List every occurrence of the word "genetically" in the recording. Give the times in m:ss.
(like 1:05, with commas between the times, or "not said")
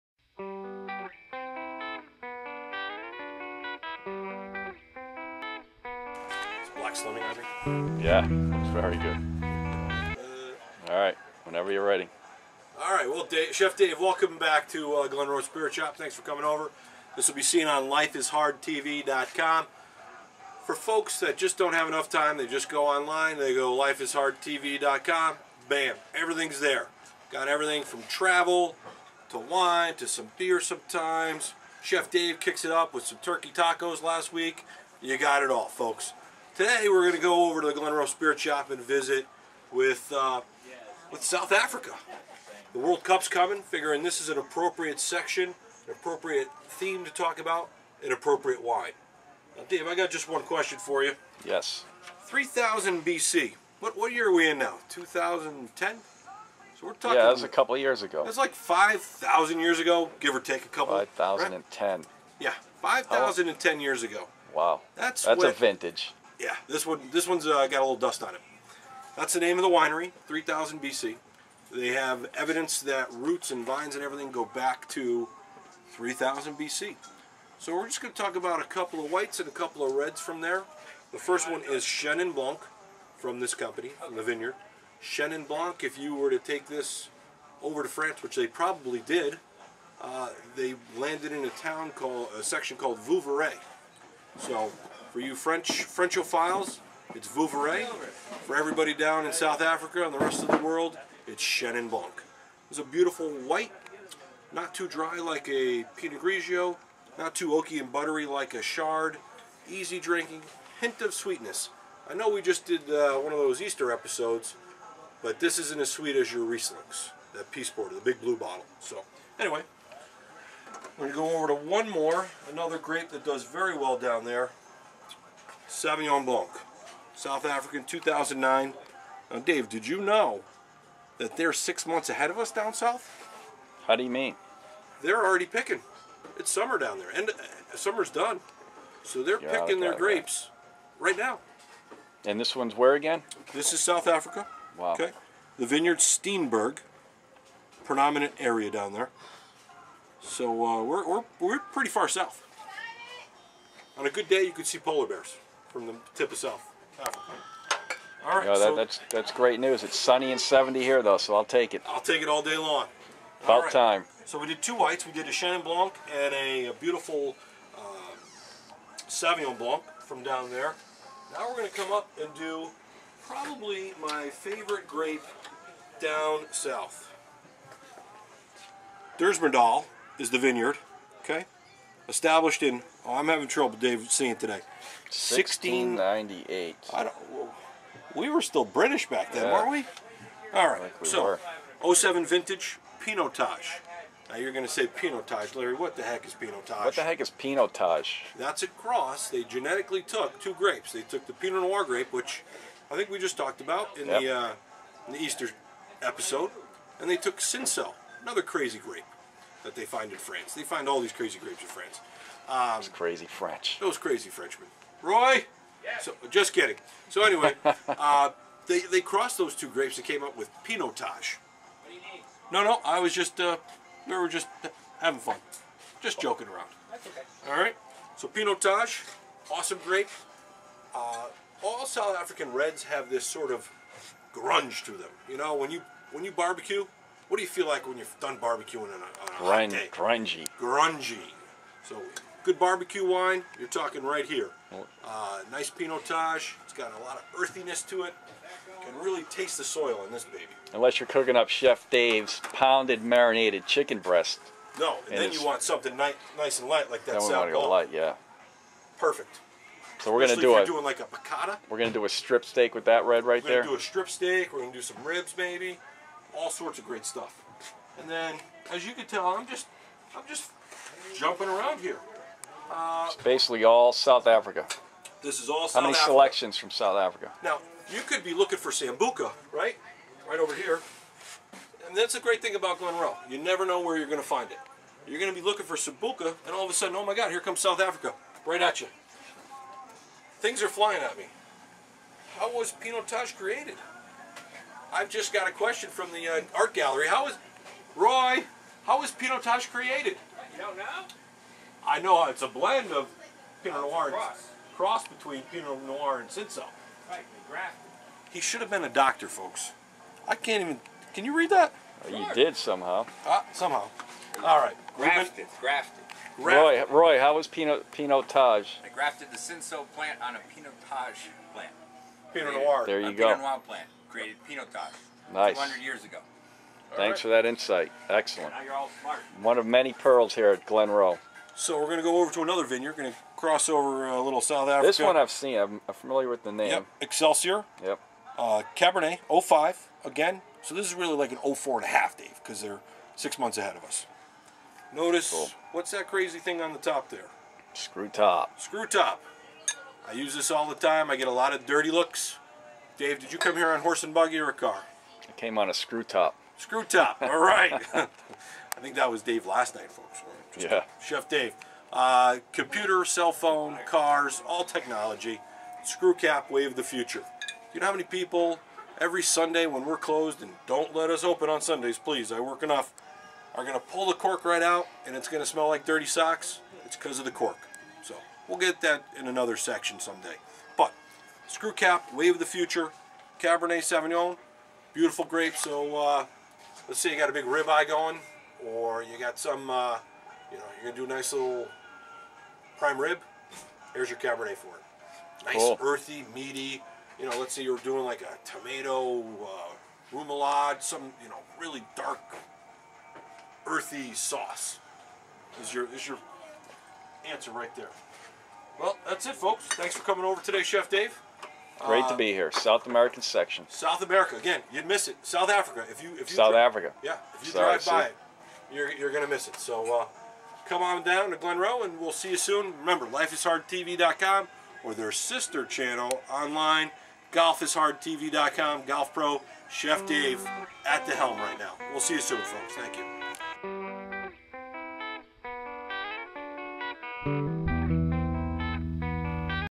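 3:19.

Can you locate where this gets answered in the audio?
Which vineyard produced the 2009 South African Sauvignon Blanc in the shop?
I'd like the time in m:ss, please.
2:25.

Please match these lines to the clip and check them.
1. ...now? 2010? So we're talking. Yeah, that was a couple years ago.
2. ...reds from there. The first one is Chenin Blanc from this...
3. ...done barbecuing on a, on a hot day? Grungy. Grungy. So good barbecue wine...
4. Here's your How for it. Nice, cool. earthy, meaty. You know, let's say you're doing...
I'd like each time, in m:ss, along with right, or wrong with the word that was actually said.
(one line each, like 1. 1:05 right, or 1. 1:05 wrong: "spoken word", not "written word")
1. 0:54 right
2. 1:19 right
3. 3:58 right
4. 6:33 wrong: "Cabernet", not "How".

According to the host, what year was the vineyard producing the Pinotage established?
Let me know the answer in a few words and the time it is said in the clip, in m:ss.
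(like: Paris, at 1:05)
1698, at 3:05.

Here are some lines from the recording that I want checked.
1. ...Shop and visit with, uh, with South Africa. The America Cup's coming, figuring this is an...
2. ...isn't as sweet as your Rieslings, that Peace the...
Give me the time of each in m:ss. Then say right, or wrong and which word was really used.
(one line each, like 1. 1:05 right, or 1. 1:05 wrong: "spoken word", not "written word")
1. 0:38 wrong: "World", not "America"
2. 1:55 right.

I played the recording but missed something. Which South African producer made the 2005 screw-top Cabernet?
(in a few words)
Excelsior.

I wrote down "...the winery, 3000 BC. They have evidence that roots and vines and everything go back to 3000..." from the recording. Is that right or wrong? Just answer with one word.
right.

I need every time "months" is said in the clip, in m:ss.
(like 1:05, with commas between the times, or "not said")
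2:11, 5:43.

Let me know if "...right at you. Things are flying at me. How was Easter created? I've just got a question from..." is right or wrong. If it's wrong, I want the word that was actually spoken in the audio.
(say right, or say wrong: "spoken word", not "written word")
wrong: "Pinotage", not "Easter".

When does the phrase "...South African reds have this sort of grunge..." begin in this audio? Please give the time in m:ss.
3:51.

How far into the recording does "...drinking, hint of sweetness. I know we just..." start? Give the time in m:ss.
1:49.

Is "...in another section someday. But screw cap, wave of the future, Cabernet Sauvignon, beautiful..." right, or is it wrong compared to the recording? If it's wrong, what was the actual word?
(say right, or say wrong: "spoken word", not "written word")
right.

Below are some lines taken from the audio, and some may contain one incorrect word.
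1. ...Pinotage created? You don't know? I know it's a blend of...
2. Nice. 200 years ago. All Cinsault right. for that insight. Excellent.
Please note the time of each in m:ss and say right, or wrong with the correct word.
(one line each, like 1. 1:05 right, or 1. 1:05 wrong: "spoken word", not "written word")
1. 4:59 right
2. 5:25 wrong: "Thanks", not "Cinsault".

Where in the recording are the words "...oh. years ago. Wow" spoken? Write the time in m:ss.
1:03.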